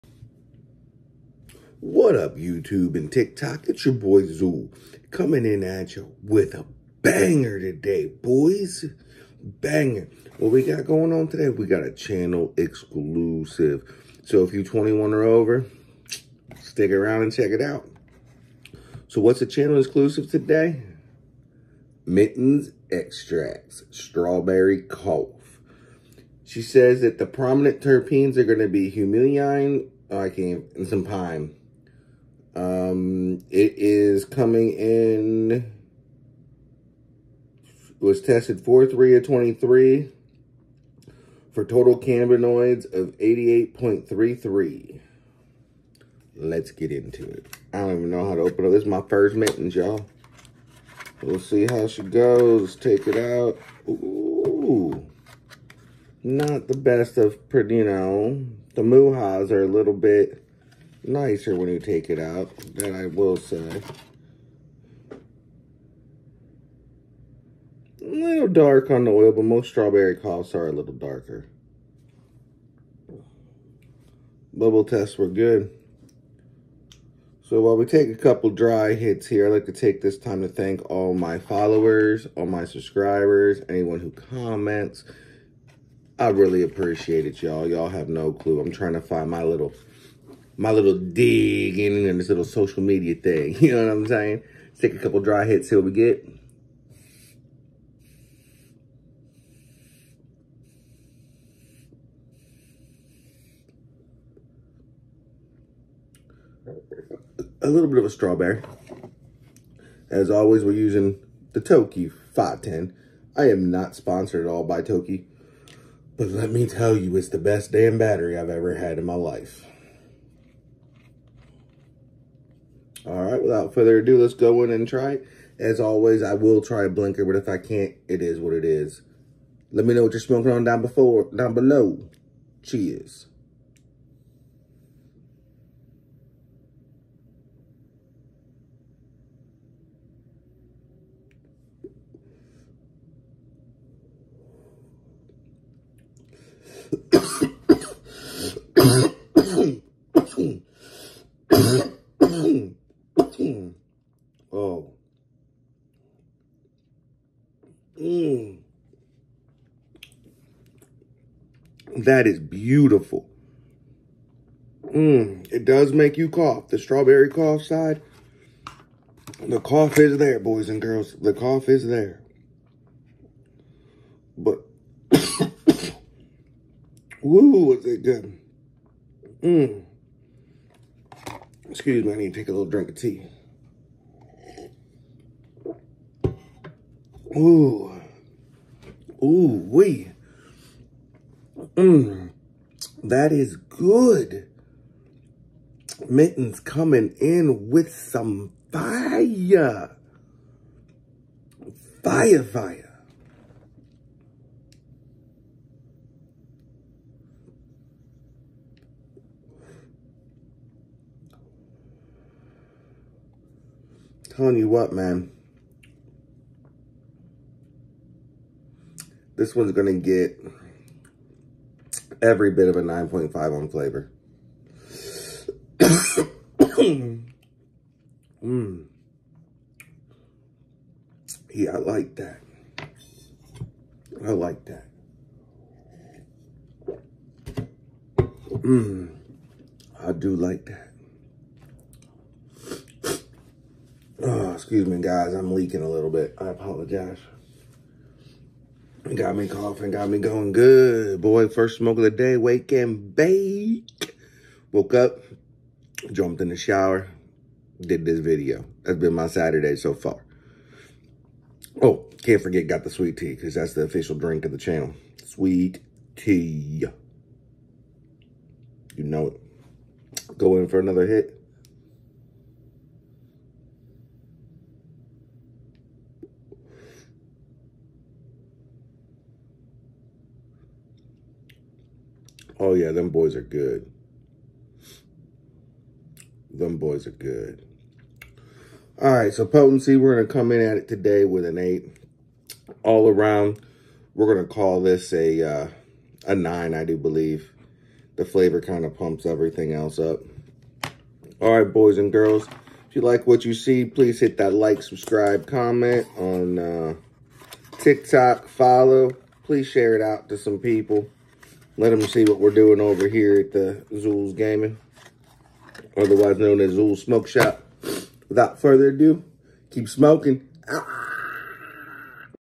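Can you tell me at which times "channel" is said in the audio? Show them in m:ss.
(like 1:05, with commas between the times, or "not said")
0:11, 0:19, 4:24.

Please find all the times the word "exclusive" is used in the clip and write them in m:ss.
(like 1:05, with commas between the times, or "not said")
0:12, 0:19.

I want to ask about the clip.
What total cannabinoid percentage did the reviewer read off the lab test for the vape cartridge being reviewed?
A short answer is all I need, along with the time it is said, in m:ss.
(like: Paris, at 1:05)
88.33, at 0:43.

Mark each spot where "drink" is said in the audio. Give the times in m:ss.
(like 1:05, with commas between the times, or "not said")
3:02, 4:24.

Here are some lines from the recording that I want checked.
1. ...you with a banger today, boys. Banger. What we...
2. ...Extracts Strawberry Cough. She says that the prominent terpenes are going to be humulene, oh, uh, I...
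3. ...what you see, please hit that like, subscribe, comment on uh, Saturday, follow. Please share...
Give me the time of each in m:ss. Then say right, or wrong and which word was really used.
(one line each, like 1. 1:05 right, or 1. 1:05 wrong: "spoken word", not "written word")
1. 0:05 right
2. 0:22 right
3. 5:03 wrong: "TikTok", not "Saturday".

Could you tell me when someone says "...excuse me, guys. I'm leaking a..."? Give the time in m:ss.
4:04.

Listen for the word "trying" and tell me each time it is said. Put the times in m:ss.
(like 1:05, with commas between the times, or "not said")
1:28.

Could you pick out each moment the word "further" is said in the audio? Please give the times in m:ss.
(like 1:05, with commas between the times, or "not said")
2:03, 5:18.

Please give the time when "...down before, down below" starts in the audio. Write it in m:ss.
2:10.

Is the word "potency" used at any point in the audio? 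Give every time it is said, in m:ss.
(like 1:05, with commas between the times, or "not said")
4:49.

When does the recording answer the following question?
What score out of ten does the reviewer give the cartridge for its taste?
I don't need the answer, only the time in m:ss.
3:42.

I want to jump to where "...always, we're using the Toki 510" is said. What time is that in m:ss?
1:50.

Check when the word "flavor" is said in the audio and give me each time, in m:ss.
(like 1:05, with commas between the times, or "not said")
3:43, 4:58.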